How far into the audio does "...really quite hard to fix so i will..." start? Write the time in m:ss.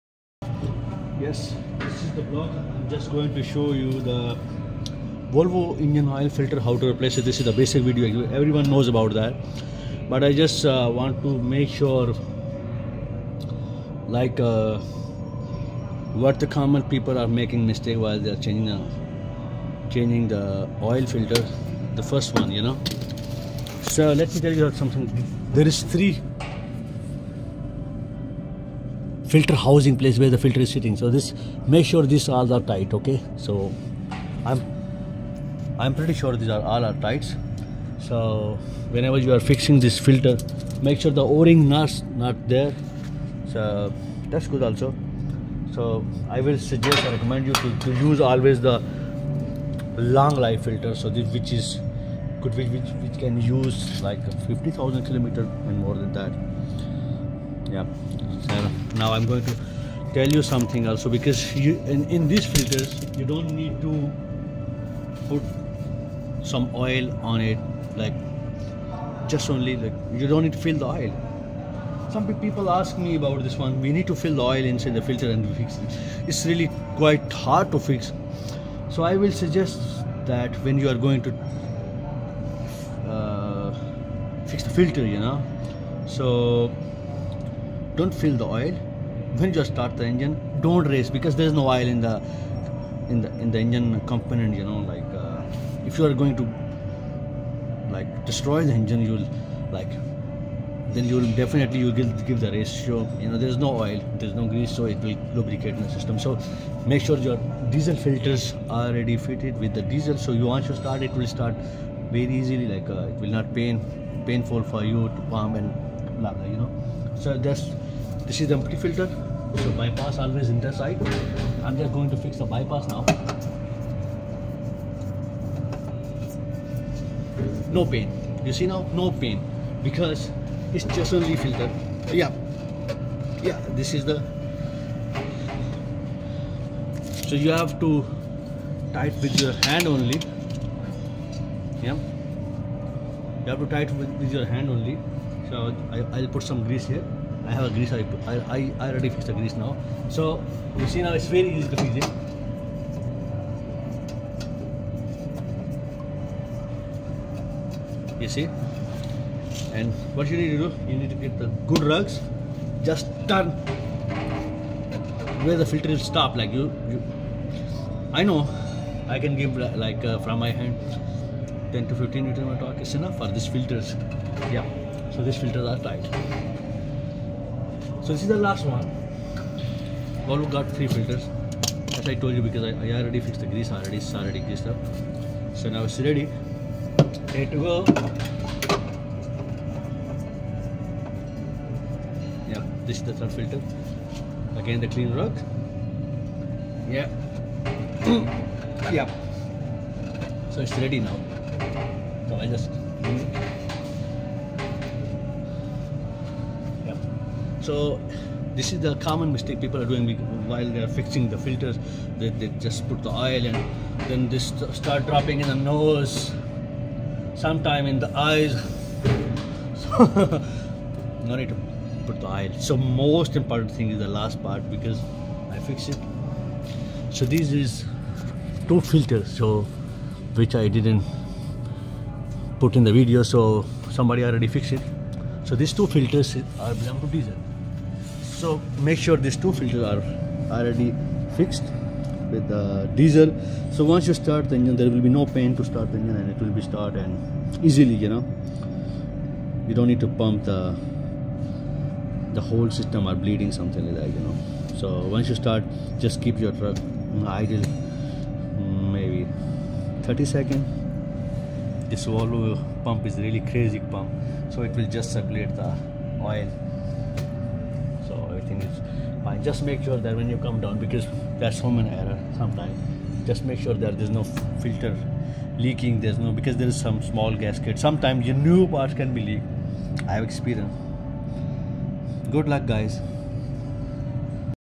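1:16.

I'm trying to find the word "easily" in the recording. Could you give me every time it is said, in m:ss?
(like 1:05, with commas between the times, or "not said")
1:52, 4:07.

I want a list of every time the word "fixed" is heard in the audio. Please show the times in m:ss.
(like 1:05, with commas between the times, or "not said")
2:29, 3:03, 3:54, 4:01.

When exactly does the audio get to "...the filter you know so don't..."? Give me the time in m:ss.
1:24.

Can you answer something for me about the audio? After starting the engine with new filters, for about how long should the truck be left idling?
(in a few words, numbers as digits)
30 seconds.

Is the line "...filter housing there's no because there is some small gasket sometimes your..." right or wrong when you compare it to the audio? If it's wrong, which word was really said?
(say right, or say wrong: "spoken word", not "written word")
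wrong: "leaking", not "housing".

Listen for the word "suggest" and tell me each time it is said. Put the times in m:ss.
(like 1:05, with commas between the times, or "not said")
0:46, 1:19.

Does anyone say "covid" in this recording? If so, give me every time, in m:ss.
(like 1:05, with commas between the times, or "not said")
not said.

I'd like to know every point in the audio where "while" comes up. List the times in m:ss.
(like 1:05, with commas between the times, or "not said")
0:18, 3:30.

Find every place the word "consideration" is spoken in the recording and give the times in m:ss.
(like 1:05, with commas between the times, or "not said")
not said.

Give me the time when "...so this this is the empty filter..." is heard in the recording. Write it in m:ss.
1:57.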